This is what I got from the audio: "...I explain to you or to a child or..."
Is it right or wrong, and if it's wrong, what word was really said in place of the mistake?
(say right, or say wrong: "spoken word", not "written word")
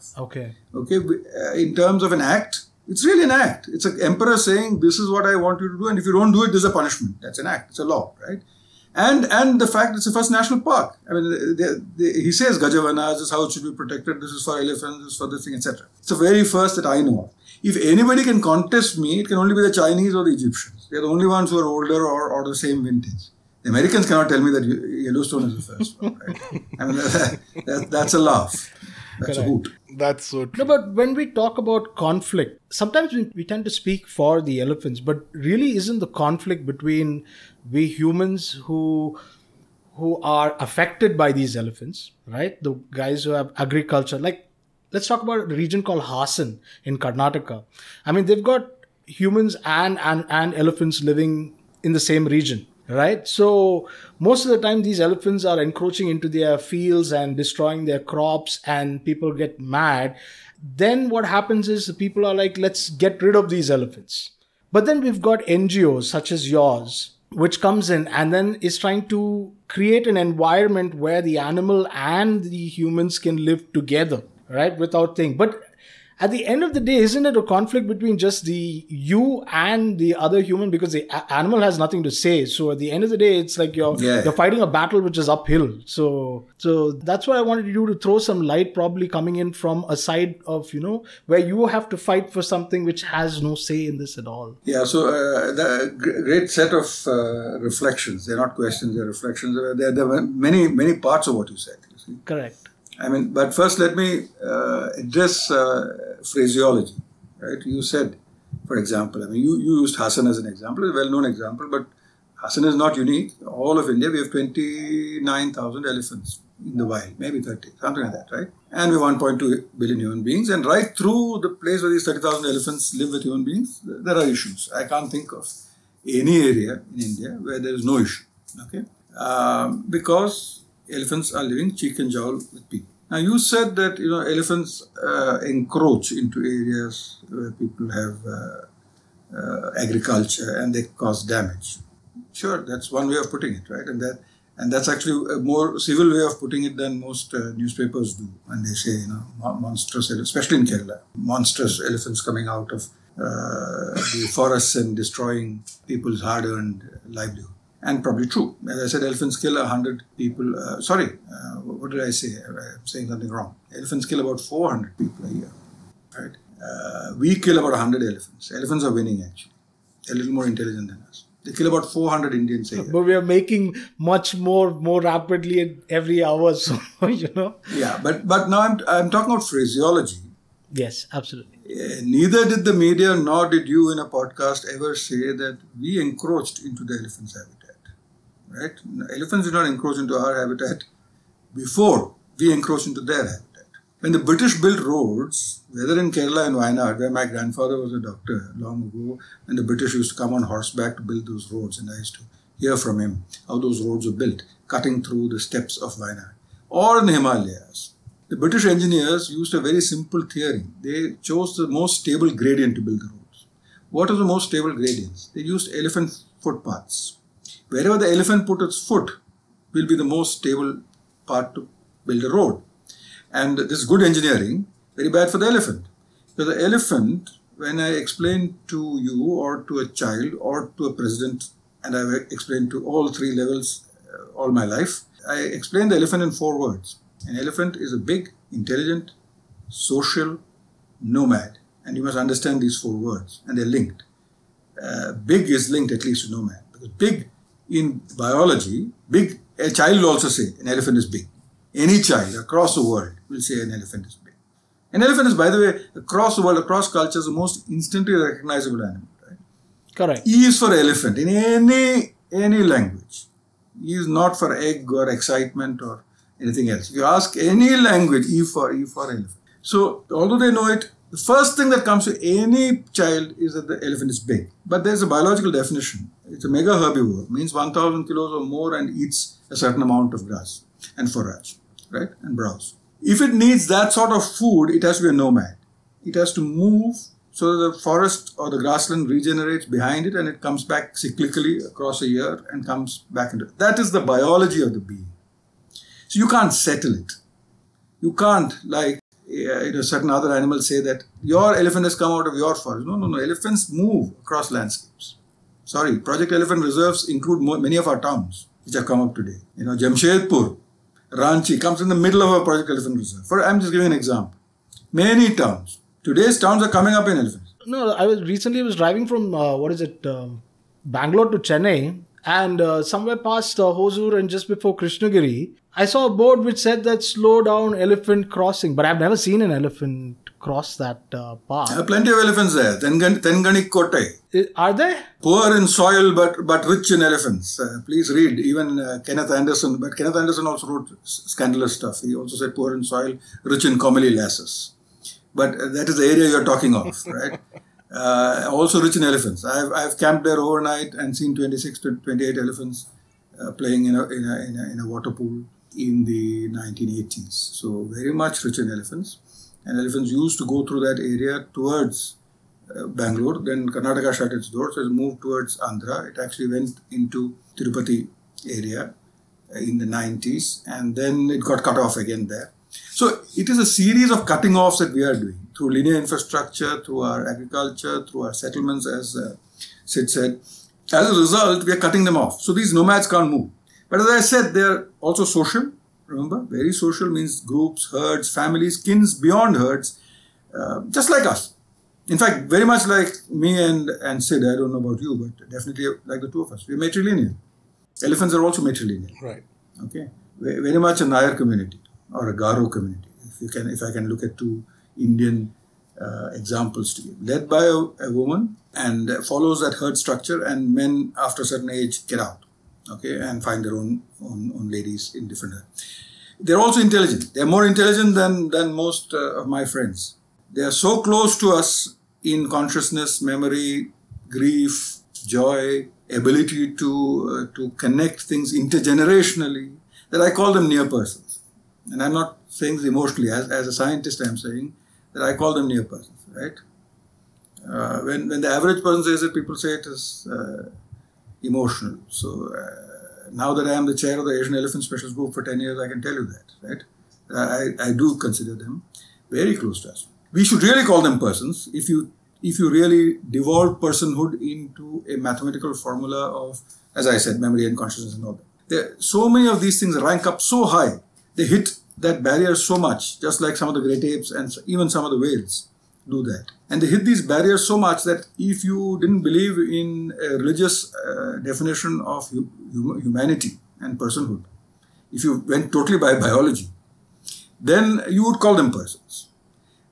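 right.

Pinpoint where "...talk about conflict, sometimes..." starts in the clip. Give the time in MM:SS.
00:31.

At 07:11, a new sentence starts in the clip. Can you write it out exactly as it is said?
And I'm not saying this emotionally.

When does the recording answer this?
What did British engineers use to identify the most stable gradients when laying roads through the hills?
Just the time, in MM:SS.
03:35.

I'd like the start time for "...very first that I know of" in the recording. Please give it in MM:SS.
00:16.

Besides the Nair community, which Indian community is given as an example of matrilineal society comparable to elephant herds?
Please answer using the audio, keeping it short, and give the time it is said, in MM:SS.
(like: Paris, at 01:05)
Garo, at 06:42.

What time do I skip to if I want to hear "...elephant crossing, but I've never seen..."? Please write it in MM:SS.
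05:27.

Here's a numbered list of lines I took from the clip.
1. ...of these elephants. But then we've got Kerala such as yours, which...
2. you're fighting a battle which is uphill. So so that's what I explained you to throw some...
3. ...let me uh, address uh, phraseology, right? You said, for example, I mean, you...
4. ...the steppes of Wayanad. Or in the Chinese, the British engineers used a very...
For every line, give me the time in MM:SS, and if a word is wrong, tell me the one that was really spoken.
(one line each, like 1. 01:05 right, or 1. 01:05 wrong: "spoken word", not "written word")
1. 01:03 wrong: "NGOs", not "Kerala"
2. 01:24 wrong: "wanted", not "explained"
3. 01:43 right
4. 03:25 wrong: "Himalayas", not "Chinese".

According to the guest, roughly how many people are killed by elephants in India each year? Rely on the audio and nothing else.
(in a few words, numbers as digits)
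400.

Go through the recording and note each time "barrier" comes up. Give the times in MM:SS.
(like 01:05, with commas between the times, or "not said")
07:42, 07:47.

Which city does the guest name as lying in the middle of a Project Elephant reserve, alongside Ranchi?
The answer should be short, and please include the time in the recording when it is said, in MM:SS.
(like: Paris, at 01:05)
Jamshedpur, at 05:09.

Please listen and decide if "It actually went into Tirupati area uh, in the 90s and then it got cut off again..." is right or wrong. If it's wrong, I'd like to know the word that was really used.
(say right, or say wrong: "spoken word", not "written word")
right.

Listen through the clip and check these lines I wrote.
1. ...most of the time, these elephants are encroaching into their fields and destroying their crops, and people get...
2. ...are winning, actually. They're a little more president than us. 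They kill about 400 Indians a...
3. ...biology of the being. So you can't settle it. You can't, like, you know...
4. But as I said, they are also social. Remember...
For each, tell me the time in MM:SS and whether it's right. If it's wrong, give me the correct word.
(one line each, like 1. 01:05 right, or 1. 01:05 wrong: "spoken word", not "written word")
1. 00:54 right
2. 02:48 wrong: "intelligent", not "president"
3. 04:53 right
4. 06:23 right.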